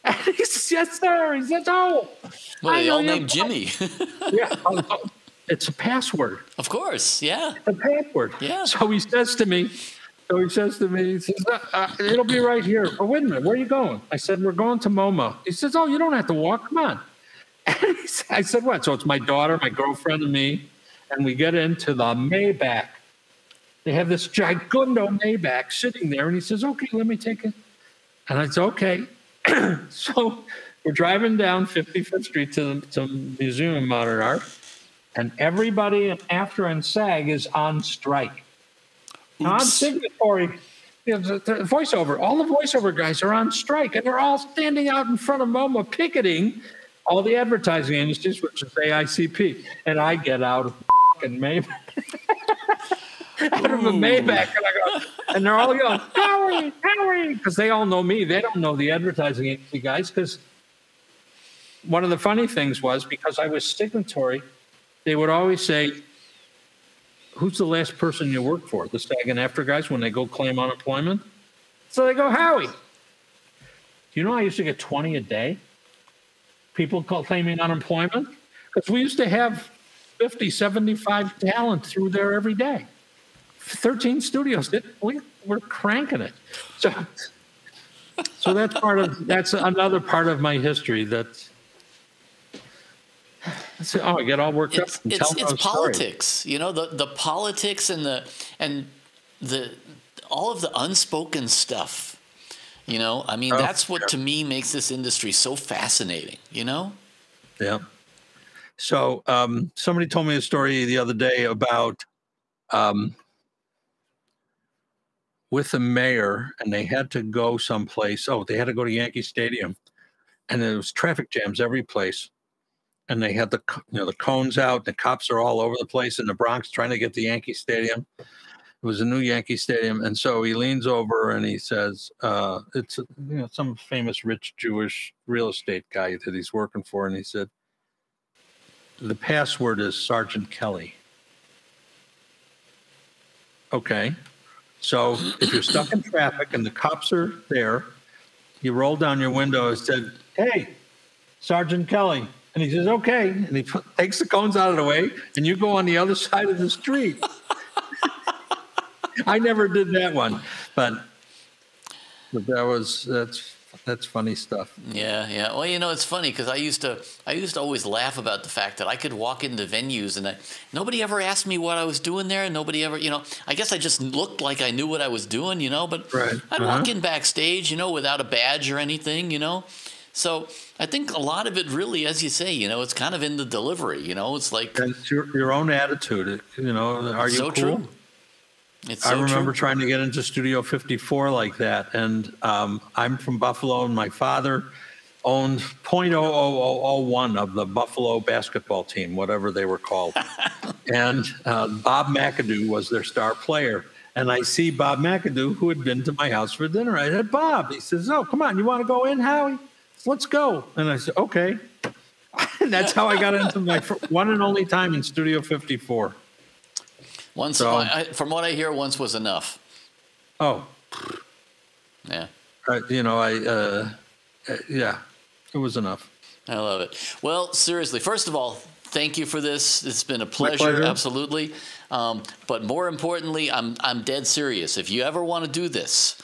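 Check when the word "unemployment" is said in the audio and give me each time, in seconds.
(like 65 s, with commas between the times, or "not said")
70 s, 77 s.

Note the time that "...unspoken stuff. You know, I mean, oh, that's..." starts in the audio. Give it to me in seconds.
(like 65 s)
100 s.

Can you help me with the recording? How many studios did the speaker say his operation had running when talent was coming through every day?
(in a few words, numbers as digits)
13.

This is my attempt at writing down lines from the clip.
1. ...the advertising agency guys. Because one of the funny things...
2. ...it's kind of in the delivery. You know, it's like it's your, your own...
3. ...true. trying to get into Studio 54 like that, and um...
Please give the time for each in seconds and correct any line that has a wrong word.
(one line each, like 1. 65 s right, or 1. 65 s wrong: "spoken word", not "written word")
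1. 58 s right
2. 182 s right
3. 189 s right.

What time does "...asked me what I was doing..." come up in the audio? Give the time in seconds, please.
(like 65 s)
171 s.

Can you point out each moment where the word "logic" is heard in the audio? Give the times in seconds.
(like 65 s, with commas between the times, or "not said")
not said.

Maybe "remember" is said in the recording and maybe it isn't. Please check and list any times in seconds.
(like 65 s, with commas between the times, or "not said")
189 s.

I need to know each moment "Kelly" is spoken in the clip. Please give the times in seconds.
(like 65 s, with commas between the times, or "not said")
140 s, 151 s.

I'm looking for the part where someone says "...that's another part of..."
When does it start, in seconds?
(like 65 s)
89 s.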